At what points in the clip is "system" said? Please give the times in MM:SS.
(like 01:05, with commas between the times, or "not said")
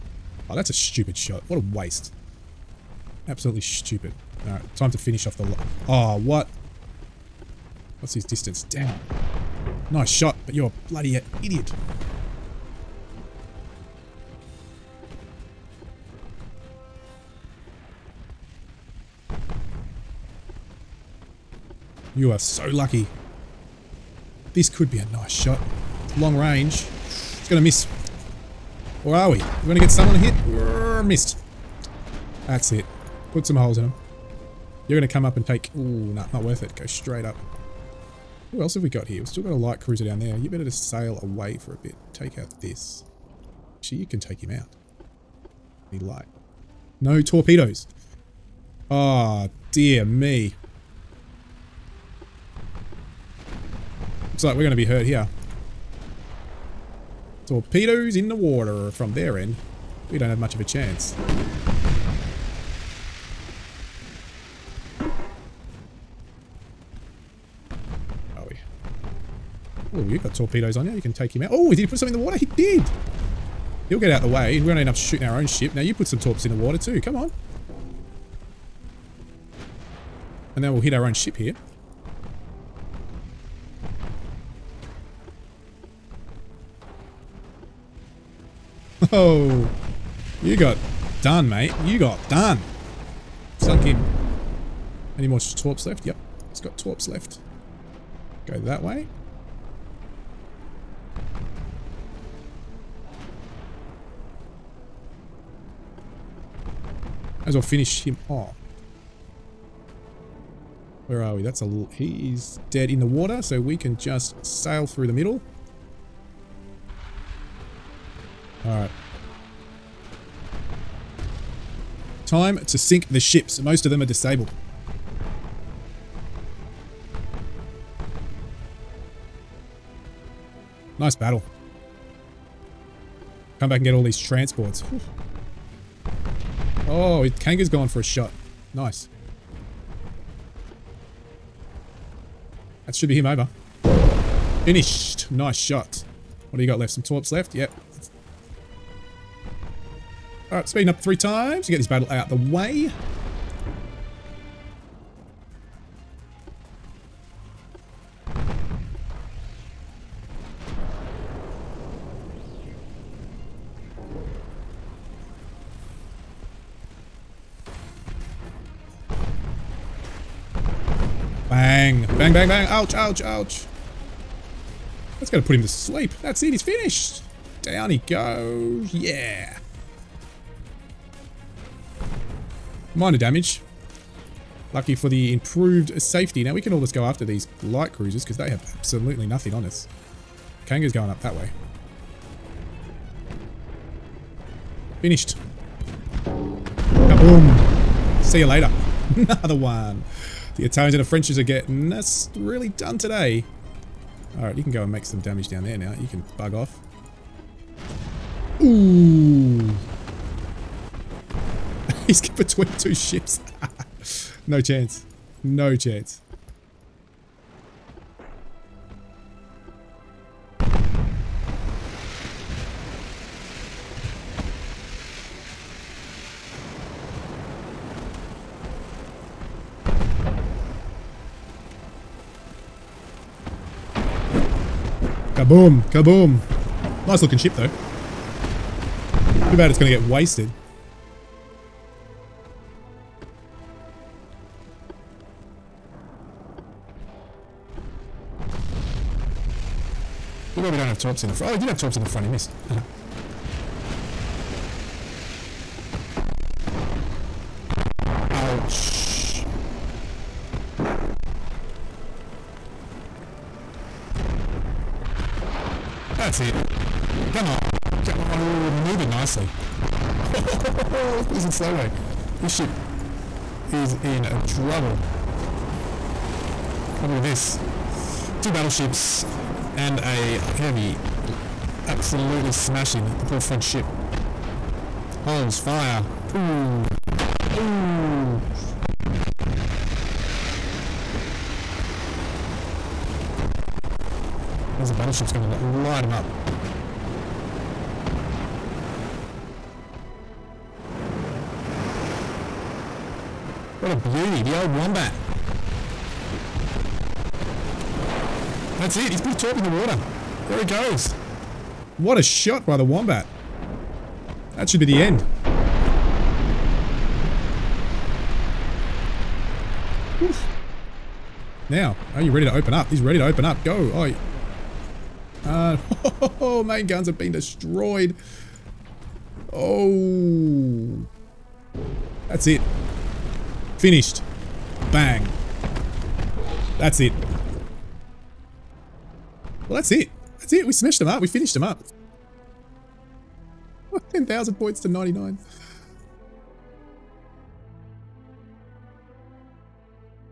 not said.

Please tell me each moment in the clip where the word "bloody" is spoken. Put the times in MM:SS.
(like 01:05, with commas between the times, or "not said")
00:10.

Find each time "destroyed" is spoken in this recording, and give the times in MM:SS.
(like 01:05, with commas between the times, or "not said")
05:27.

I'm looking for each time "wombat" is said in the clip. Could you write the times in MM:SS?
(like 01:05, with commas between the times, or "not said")
05:04, 05:12.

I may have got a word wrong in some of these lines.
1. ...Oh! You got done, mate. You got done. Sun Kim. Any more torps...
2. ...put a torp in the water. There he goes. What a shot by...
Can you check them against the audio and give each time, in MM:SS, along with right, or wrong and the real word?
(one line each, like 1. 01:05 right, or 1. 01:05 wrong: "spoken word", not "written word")
1. 01:29 right
2. 05:09 right.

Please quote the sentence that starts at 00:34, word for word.
You're going to come up and take...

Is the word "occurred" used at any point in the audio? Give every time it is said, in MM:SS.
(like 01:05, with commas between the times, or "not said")
not said.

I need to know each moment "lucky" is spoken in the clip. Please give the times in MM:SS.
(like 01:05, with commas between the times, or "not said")
00:22, 03:04.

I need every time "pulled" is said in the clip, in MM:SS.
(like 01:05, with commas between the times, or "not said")
not said.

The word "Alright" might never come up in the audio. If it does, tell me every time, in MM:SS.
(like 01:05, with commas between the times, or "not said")
00:04, 01:58, 02:30, 03:24.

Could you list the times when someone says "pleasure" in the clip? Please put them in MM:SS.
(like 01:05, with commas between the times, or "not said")
not said.